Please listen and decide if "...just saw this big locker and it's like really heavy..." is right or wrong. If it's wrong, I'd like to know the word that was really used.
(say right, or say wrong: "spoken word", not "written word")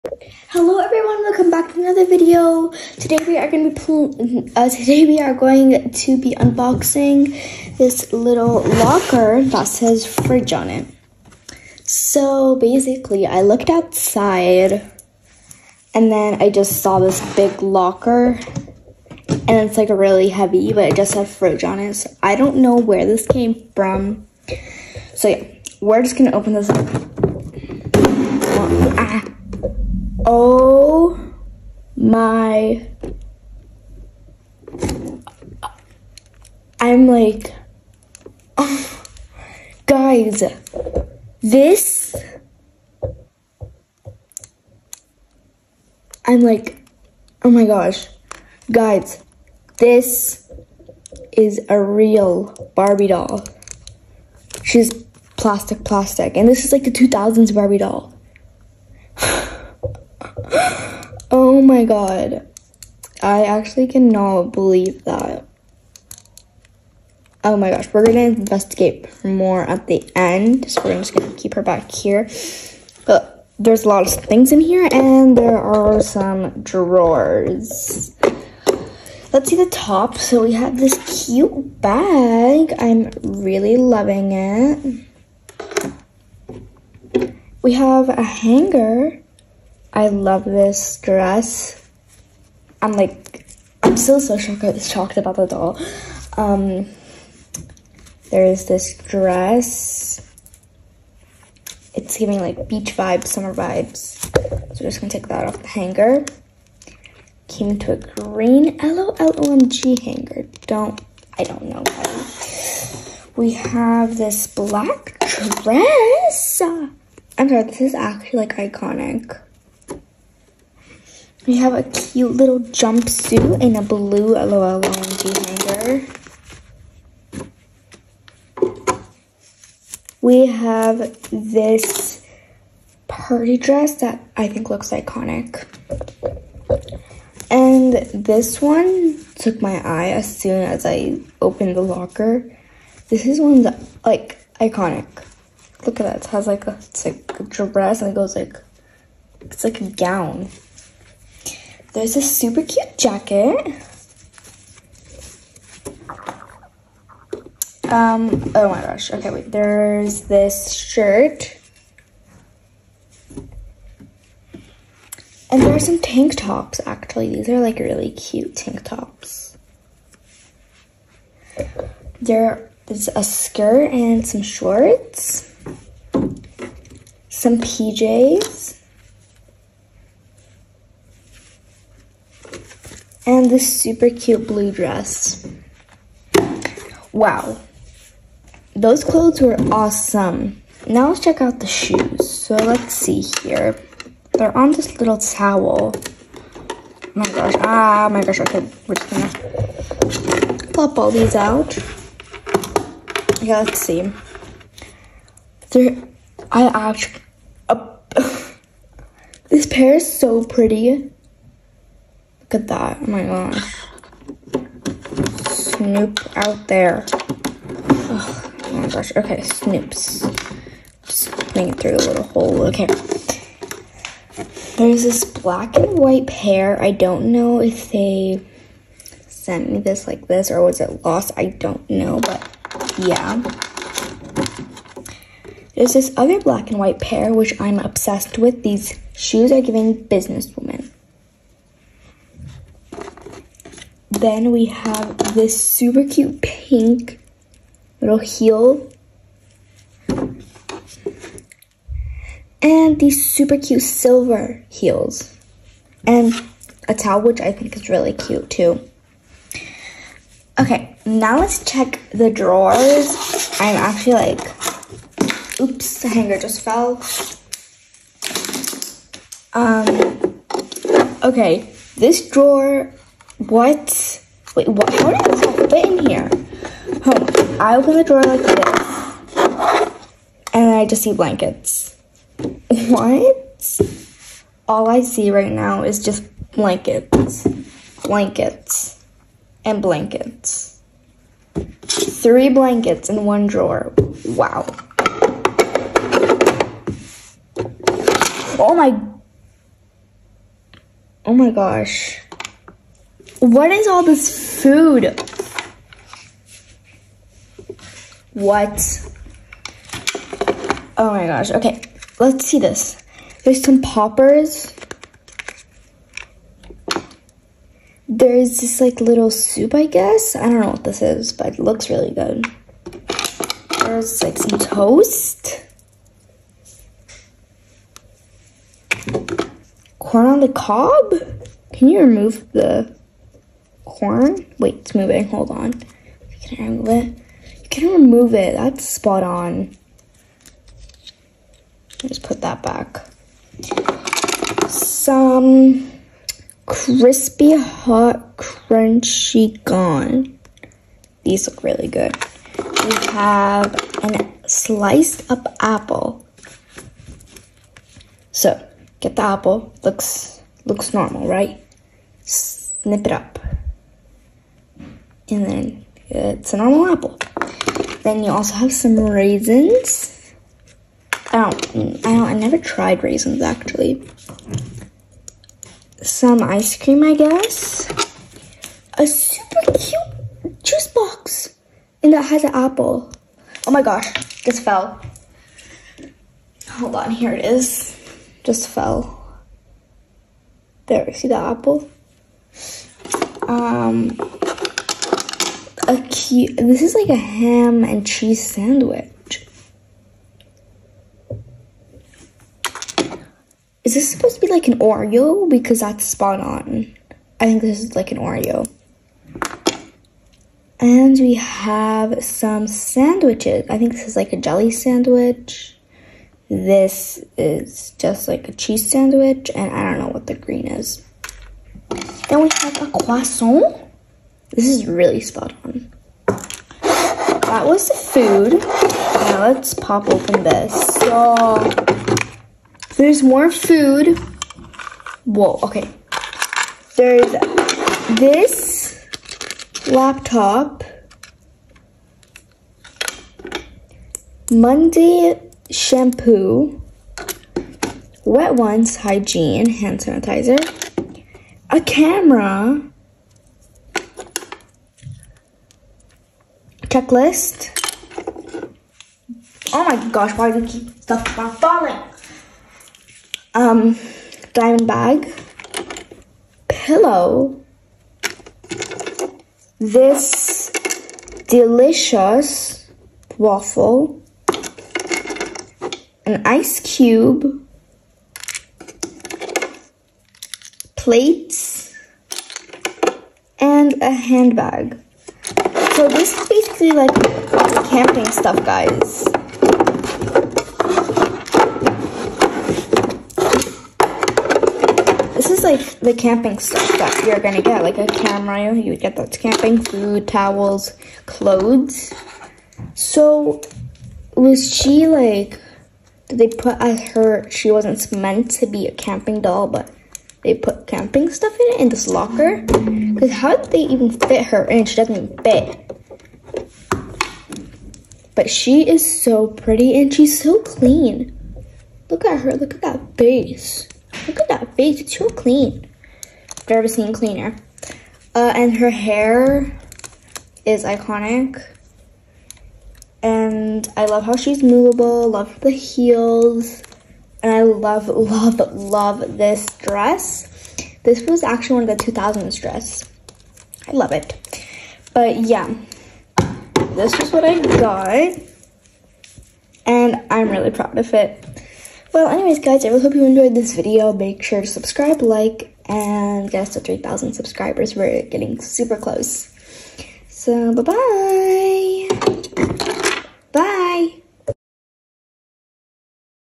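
right.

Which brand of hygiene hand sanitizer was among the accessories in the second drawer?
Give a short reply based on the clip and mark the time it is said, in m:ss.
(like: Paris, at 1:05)
Wet Ones, at 7:28.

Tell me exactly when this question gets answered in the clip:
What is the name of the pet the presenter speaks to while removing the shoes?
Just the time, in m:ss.
3:35.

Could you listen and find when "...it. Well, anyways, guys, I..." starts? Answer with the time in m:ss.
9:11.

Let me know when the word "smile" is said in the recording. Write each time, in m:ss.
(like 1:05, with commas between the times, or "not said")
not said.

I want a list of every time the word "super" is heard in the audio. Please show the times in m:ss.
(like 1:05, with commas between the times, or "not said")
2:32, 3:03, 4:05, 4:13, 6:19, 9:18.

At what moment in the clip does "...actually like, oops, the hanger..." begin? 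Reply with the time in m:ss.
4:23.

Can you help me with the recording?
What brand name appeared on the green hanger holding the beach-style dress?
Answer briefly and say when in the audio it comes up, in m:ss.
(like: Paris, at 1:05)
LOLOMG, at 1:48.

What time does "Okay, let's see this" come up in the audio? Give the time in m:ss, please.
5:11.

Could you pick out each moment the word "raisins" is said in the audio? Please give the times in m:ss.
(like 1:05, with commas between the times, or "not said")
6:08, 6:13.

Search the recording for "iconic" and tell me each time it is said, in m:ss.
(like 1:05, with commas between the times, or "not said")
1:58, 2:14, 2:24, 8:50.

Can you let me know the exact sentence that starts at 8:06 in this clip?
So this is basically like camping stuff, guys.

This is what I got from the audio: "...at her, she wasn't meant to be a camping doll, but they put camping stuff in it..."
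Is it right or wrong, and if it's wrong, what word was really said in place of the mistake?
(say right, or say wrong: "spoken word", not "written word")
right.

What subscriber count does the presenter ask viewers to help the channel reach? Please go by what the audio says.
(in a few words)
3,000.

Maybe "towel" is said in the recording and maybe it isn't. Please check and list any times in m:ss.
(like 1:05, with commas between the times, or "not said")
3:15, 4:16, 8:20.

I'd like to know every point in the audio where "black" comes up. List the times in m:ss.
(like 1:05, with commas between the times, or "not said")
1:54, 3:45, 3:56.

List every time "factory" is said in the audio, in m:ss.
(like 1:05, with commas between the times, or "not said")
not said.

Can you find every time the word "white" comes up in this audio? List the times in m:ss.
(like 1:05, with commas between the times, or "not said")
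3:45, 3:56.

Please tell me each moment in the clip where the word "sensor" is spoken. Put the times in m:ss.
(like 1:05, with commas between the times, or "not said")
not said.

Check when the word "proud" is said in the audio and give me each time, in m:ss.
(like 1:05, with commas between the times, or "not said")
9:10.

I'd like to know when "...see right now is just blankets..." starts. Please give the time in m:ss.
4:45.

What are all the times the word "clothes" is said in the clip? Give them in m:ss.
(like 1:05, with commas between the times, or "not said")
3:09, 8:21.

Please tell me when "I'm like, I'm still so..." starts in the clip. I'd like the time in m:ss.
1:32.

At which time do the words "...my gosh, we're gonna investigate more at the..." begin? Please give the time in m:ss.
1:07.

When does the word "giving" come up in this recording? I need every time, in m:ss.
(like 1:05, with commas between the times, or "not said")
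1:42, 3:59.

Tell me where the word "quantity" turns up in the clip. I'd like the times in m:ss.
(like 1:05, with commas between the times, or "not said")
not said.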